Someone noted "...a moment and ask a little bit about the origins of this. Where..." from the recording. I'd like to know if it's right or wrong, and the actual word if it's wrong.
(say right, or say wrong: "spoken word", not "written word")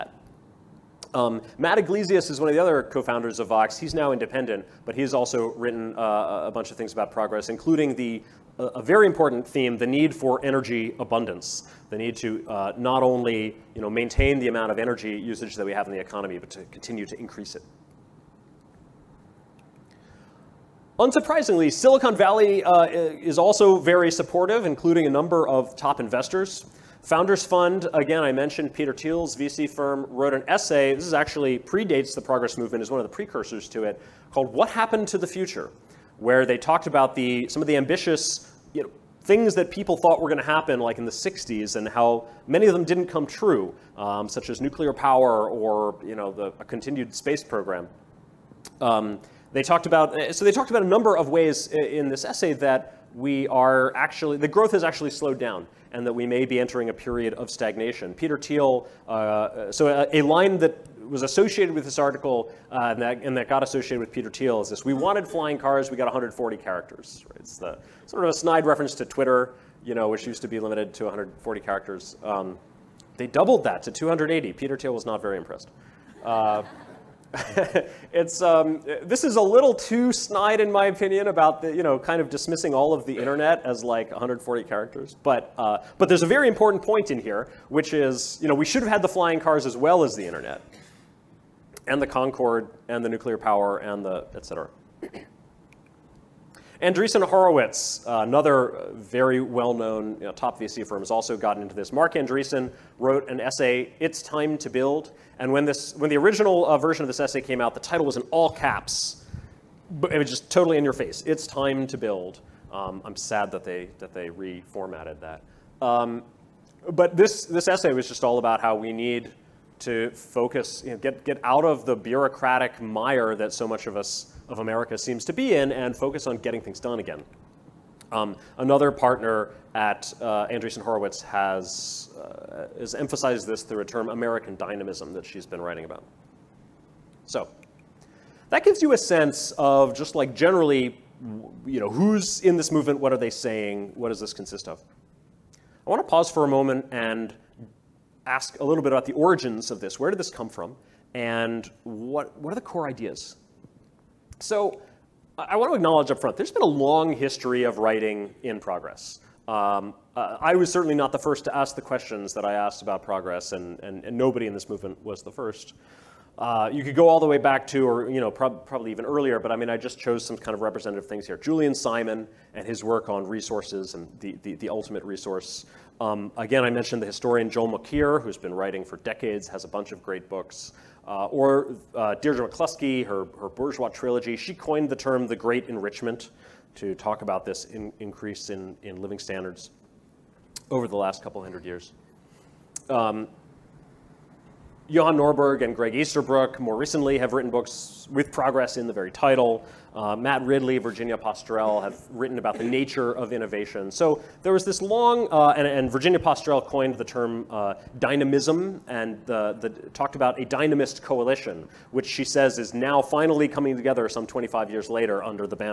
right.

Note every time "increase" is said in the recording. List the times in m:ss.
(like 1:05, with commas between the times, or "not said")
0:17, 3:07.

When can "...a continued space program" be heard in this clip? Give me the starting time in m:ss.
0:46.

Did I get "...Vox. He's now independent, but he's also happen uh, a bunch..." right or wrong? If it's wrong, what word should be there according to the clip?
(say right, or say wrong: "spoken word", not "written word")
wrong: "written", not "happen".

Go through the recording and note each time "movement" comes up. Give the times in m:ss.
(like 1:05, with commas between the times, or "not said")
0:32, 2:22, 2:44.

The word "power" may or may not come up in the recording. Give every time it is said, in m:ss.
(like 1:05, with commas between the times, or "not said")
0:44, 1:33.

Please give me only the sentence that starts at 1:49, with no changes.
But it was just totally in your face.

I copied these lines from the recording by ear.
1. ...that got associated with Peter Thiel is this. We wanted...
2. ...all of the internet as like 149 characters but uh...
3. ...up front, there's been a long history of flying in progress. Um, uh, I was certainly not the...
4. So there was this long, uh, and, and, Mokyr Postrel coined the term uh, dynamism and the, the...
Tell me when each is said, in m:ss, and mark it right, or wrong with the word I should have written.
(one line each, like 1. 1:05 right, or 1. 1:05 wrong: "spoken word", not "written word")
1. 1:03 right
2. 1:22 wrong: "140", not "149"
3. 2:36 wrong: "writing", not "flying"
4. 3:23 wrong: "Virginia", not "Mokyr".